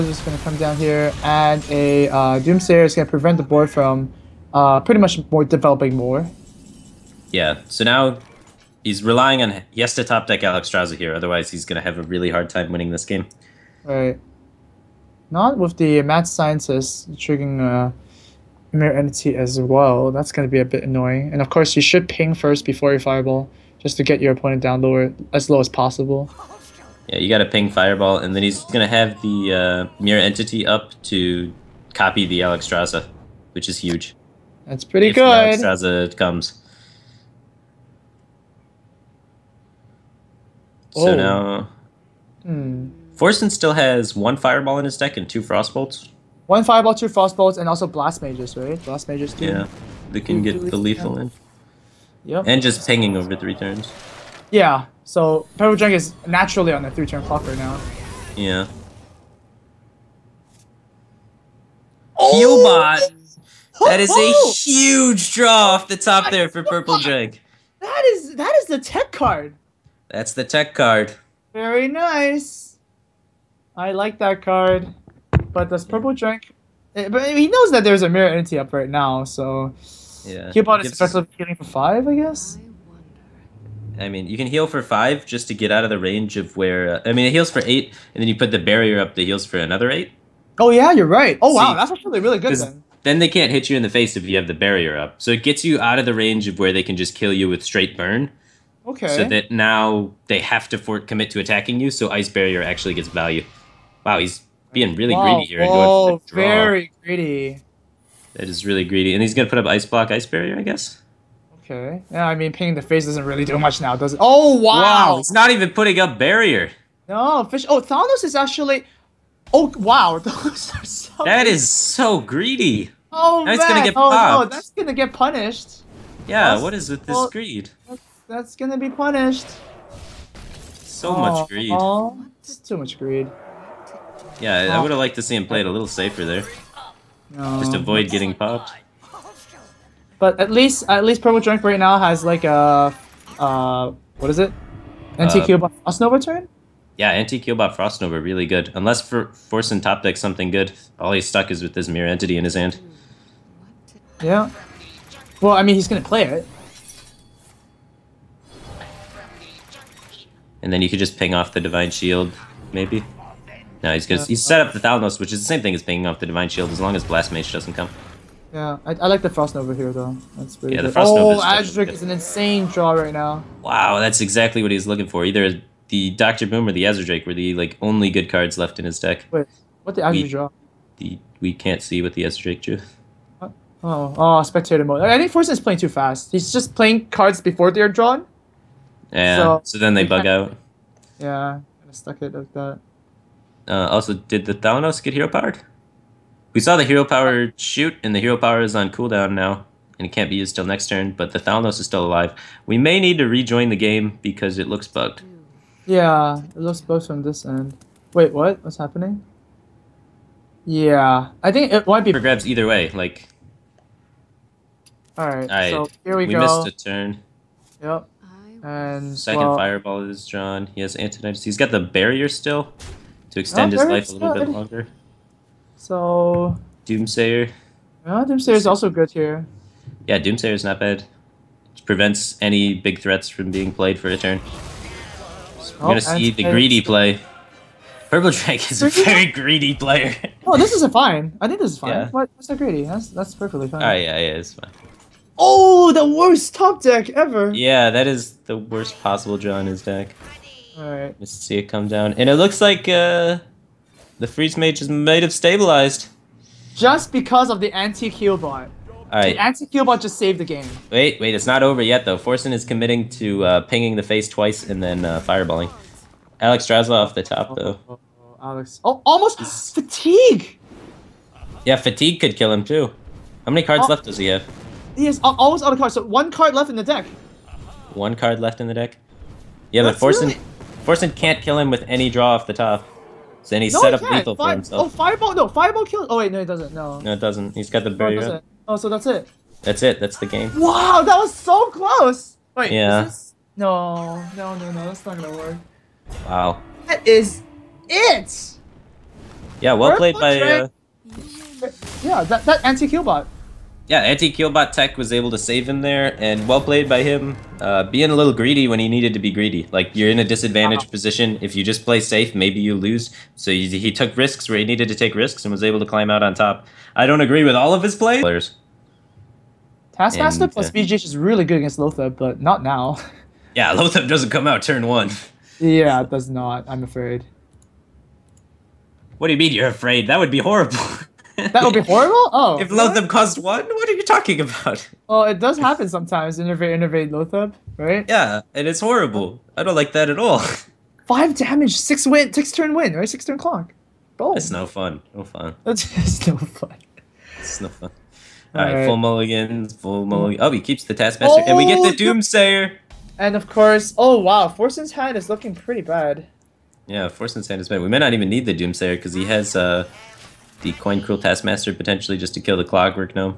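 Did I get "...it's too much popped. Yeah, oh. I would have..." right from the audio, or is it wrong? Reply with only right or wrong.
wrong.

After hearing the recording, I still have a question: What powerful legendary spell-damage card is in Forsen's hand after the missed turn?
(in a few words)
Antonidas.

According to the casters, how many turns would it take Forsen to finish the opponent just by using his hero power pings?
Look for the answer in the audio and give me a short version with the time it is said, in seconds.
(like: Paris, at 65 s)
3, at 53 s.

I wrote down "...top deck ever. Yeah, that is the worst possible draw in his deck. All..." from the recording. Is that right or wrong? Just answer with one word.
right.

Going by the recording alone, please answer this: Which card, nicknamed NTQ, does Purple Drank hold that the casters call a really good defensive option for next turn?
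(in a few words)
Frost Nova.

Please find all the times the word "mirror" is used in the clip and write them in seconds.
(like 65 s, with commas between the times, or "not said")
18 s, 30 s, 78 s, 151 s.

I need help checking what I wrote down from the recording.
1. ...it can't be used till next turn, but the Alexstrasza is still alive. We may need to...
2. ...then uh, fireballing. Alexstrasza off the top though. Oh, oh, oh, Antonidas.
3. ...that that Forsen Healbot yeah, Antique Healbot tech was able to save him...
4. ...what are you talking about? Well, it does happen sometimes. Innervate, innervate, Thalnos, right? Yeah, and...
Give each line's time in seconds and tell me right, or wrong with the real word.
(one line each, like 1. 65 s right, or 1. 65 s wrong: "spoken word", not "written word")
1. 200 s wrong: "Thalnos", not "Alexstrasza"
2. 264 s wrong: "Alex", not "Antonidas"
3. 302 s wrong: "Antique", not "Forsen"
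4. 333 s wrong: "Loatheb", not "Thalnos".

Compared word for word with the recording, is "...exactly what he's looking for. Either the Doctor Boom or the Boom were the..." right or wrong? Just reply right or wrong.
wrong.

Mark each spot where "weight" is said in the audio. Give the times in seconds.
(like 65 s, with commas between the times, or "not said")
not said.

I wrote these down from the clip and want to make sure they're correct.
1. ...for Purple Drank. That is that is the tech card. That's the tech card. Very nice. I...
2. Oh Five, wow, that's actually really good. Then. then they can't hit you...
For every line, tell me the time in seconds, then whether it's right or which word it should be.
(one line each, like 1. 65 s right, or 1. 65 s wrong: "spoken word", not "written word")
1. 66 s right
2. 91 s wrong: "See", not "Five".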